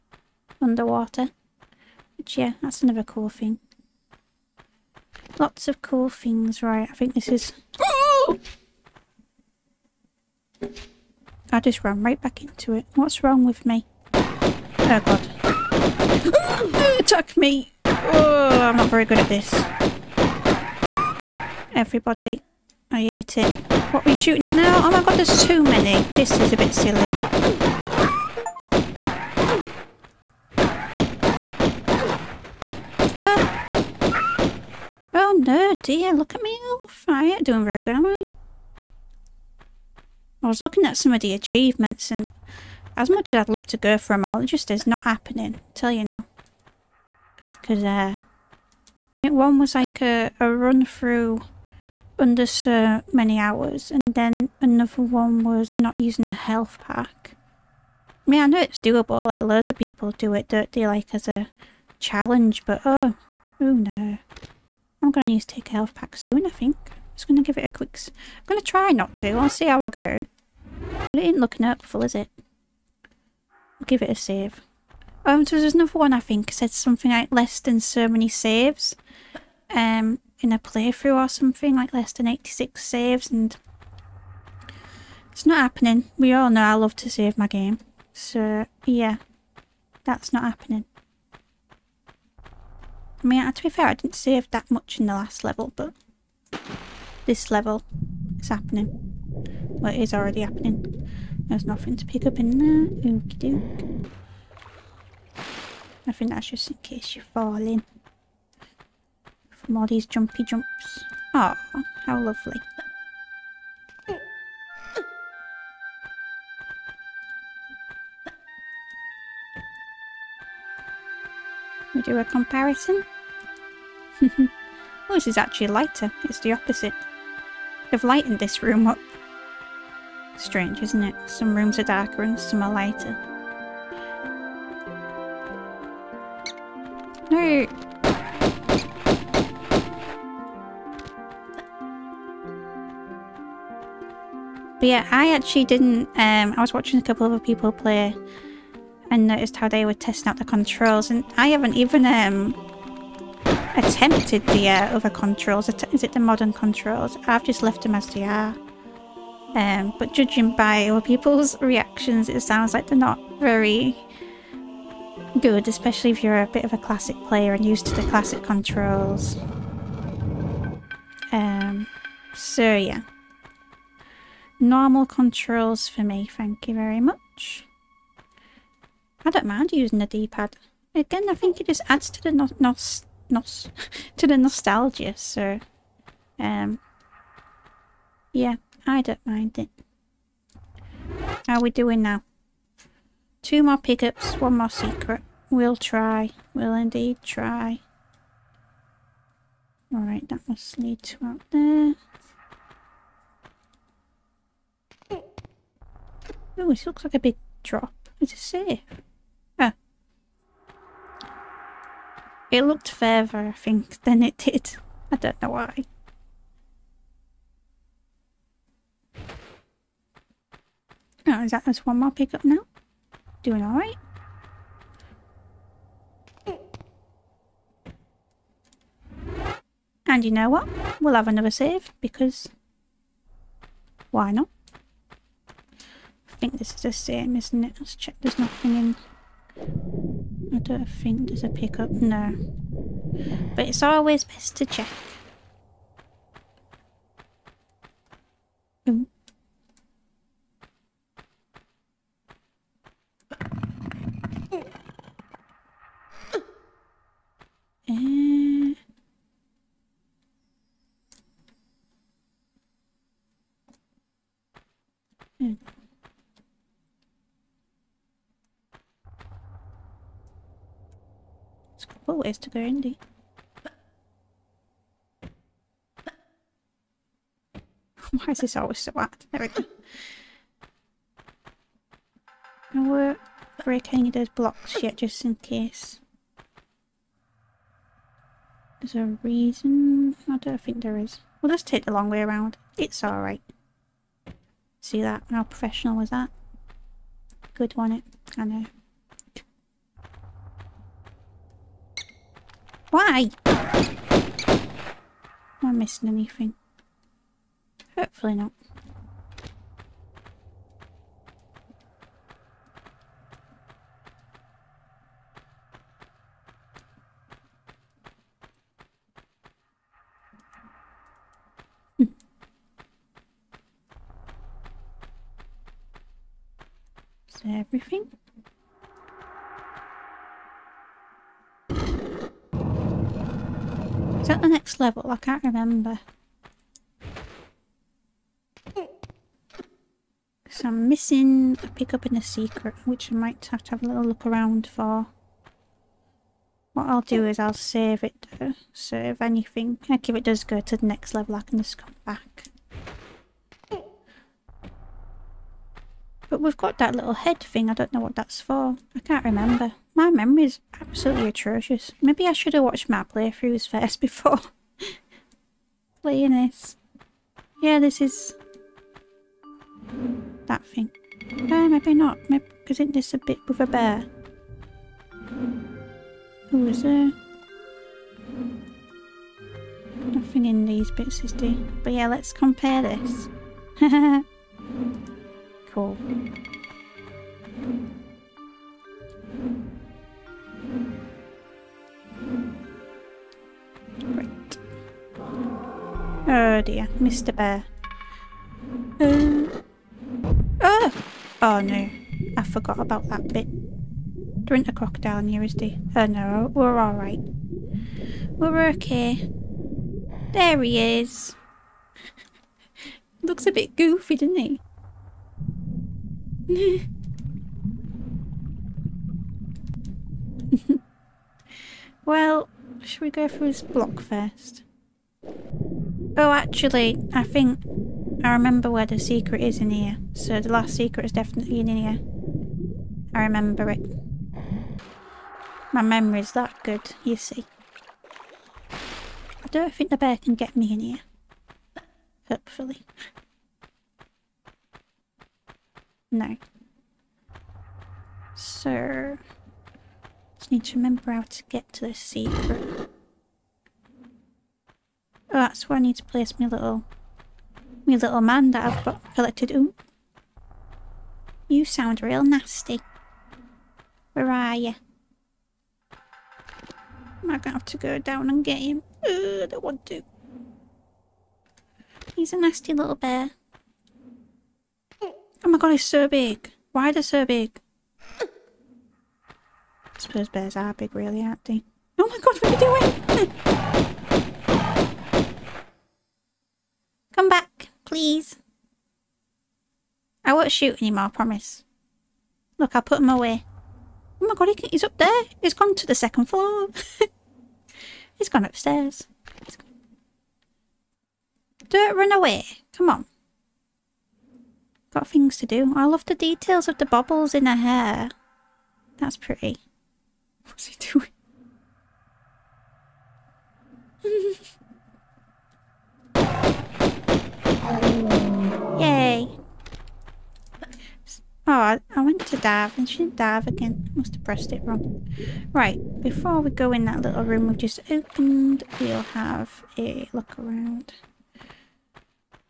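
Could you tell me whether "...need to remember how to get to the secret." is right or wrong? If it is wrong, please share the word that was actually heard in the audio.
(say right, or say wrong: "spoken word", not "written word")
right.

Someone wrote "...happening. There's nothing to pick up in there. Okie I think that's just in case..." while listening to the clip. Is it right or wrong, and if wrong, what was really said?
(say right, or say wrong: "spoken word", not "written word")
right.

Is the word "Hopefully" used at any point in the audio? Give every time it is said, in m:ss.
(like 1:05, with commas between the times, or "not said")
5:07, 7:22.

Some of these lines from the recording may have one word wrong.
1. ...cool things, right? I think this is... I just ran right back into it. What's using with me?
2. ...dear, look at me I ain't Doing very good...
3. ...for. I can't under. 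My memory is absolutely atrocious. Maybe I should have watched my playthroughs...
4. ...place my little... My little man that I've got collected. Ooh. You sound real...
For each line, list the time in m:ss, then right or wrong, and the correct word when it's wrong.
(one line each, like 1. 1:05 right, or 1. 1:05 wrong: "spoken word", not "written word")
1. 0:05 wrong: "wrong", not "using"
2. 0:35 right
3. 5:58 wrong: "remember", not "under"
4. 7:36 right.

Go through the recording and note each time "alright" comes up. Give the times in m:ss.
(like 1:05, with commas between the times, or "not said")
3:19, 3:43, 4:53, 6:46.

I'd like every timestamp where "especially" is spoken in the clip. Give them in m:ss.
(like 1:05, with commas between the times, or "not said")
2:45.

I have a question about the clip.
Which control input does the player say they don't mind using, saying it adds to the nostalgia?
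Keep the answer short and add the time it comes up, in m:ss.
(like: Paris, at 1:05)
D-pad, at 3:00.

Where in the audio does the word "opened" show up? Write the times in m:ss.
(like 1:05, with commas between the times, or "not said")
8:47.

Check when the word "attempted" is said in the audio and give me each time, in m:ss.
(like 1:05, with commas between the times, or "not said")
2:33.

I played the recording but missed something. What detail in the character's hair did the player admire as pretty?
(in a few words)
bubbles.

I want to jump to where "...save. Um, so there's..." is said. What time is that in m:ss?
1:14.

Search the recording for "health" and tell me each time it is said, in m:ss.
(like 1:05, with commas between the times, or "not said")
0:56, 1:05.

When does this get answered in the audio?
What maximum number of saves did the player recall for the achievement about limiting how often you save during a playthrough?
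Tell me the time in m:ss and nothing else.
1:22.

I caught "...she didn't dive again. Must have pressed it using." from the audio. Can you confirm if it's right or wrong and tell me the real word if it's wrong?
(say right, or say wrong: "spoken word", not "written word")
wrong: "wrong", not "using".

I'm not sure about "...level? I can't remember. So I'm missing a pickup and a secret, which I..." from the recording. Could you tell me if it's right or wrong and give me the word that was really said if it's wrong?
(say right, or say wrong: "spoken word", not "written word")
right.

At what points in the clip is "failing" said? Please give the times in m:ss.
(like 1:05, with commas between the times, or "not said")
not said.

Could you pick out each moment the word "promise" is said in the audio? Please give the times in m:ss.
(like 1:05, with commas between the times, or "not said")
8:11.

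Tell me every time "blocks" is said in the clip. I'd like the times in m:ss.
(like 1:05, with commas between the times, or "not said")
4:44, 7:03.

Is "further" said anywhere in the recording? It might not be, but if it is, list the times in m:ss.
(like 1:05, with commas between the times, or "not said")
3:32.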